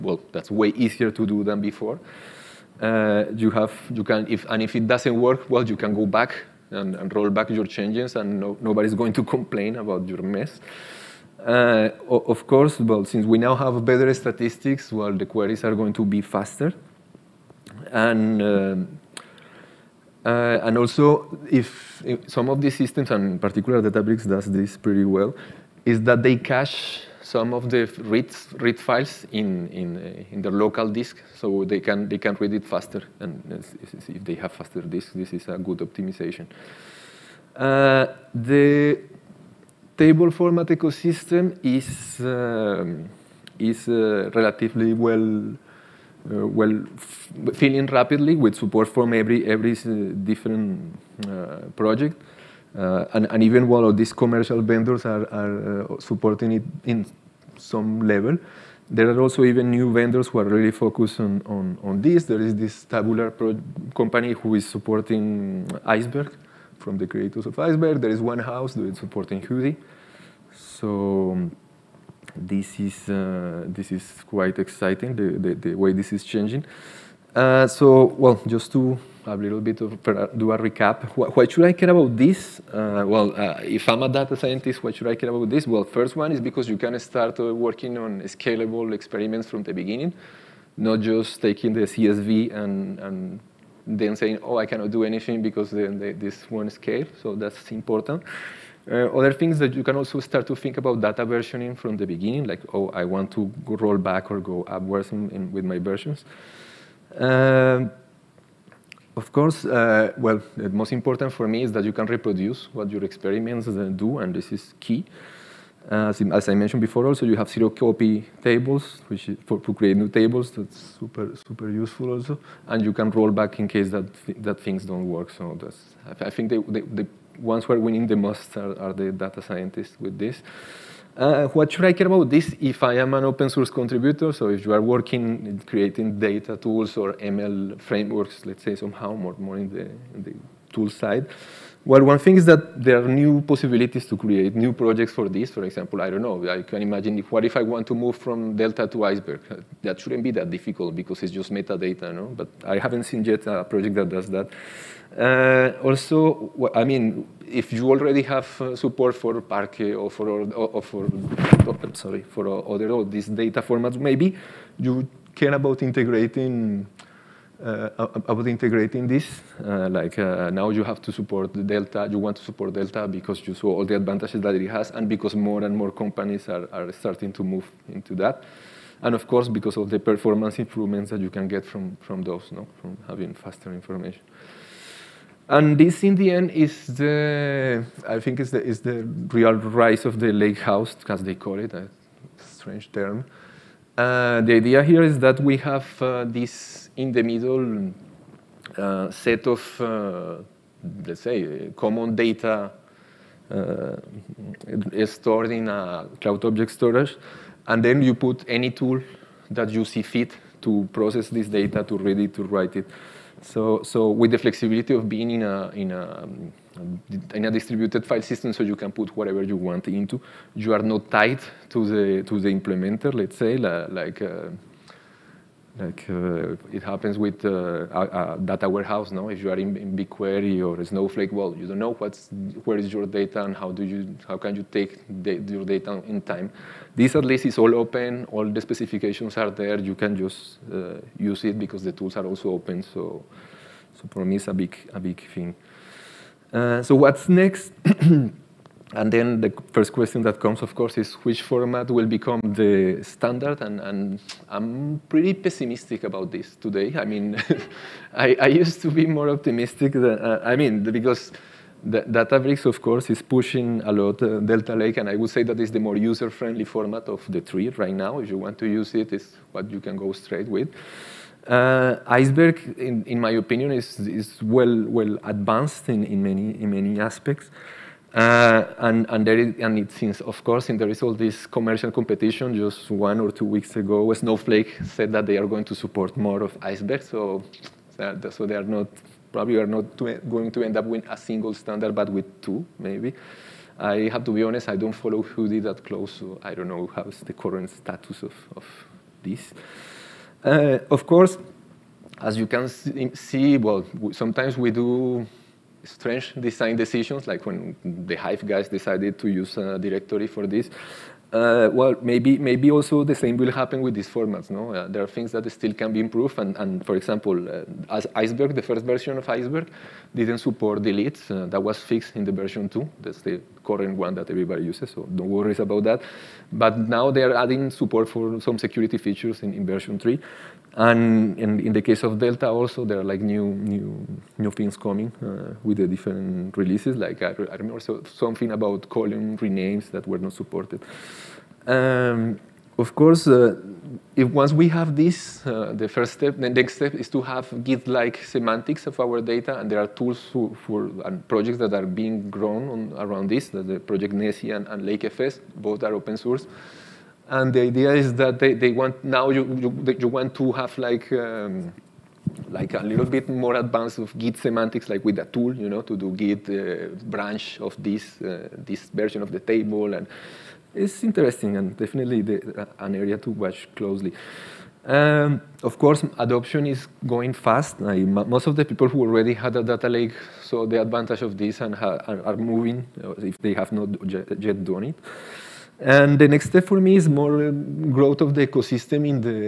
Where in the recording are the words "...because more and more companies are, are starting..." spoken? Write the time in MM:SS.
02:55.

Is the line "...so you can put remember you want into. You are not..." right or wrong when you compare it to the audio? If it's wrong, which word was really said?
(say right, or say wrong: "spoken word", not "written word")
wrong: "whatever", not "remember".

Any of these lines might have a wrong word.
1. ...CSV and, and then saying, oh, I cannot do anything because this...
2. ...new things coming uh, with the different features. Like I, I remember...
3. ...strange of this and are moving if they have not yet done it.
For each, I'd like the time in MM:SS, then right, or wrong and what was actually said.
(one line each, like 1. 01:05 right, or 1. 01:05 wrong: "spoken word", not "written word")
1. 01:31 right
2. 05:34 wrong: "releases", not "features"
3. 06:20 wrong: "advantage", not "strange".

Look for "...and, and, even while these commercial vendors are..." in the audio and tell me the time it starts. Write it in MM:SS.
00:53.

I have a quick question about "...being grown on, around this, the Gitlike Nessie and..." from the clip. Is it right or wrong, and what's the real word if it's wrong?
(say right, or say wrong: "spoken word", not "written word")
wrong: "Project", not "Gitlike".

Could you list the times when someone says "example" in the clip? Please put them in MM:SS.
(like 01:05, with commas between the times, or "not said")
02:25, 05:16.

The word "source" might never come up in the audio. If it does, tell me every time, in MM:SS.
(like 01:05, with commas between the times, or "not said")
02:13, 05:56.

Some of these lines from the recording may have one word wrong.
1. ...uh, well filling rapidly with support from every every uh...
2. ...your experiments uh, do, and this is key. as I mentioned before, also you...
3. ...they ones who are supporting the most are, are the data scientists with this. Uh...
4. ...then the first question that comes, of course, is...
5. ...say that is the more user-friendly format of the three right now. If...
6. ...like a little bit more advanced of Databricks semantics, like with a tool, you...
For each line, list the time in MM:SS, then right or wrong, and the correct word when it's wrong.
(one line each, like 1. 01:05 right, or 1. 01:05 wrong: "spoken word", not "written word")
1. 00:46 right
2. 01:52 right
3. 02:06 wrong: "winning", not "supporting"
4. 04:09 right
5. 04:25 right
6. 06:02 wrong: "Git", not "Databricks".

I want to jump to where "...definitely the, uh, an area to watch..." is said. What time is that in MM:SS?
06:11.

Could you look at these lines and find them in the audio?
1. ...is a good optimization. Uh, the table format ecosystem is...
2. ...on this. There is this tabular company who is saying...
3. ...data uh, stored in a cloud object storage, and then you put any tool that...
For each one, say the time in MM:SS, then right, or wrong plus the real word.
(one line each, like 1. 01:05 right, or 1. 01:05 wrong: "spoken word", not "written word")
1. 00:35 right
2. 01:01 wrong: "supporting", not "saying"
3. 03:22 right.